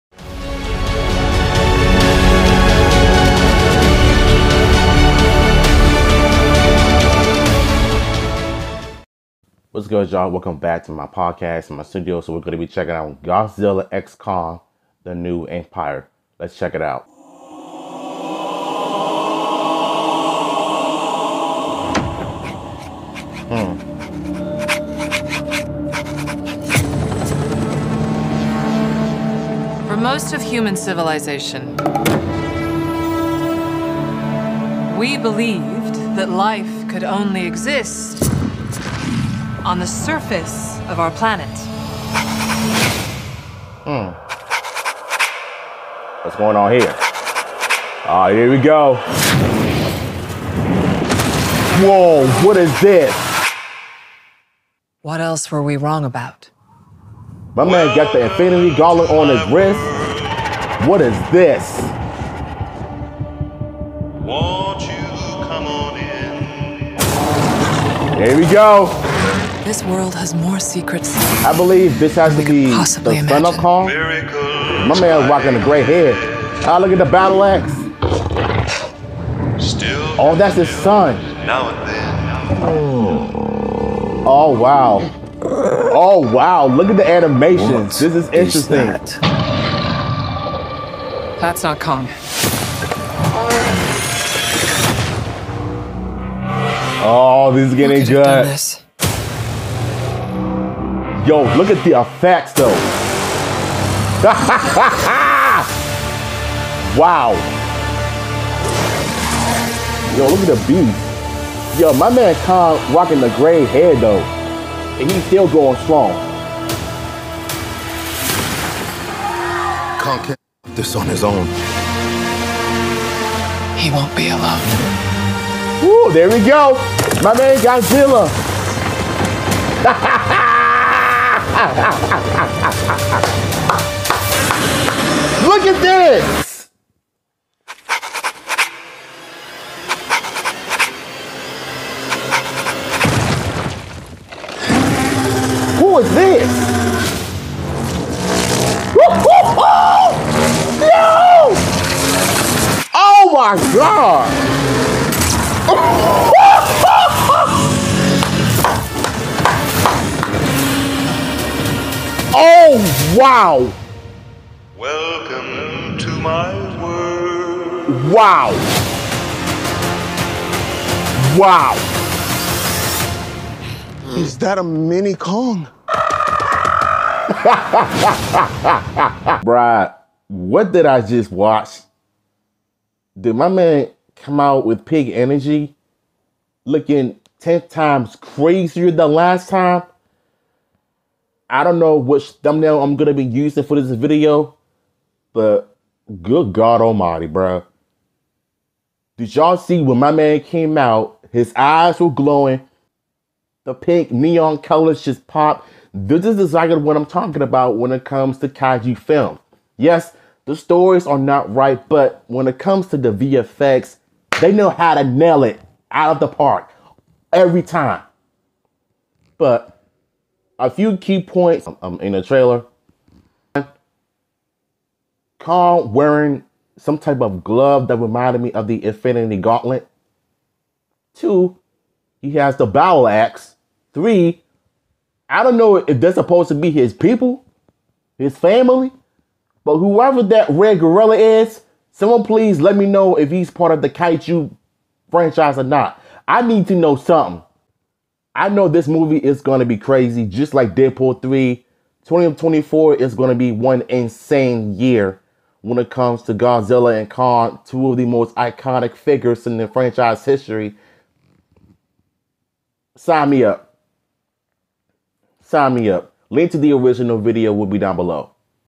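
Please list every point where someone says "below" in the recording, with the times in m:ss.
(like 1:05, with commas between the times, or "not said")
4:27.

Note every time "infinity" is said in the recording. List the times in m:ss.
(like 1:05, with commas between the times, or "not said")
0:58, 3:48.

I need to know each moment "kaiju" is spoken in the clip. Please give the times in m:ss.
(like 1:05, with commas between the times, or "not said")
3:28, 4:03.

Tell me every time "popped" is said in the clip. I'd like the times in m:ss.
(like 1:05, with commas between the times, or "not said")
3:25.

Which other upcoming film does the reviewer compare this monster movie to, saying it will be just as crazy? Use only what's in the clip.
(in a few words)
Deadpool 3.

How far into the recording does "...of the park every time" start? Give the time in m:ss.
3:36.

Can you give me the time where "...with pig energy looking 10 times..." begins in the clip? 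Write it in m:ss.
3:04.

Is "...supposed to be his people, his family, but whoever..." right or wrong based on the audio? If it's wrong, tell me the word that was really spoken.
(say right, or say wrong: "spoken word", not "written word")
right.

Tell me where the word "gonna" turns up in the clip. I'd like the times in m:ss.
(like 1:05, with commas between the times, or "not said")
3:12.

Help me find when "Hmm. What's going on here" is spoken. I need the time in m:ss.
0:43.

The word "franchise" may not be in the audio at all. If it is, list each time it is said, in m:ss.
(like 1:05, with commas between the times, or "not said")
4:05, 4:19.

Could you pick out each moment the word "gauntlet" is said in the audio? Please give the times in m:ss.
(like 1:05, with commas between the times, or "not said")
0:58, 3:49.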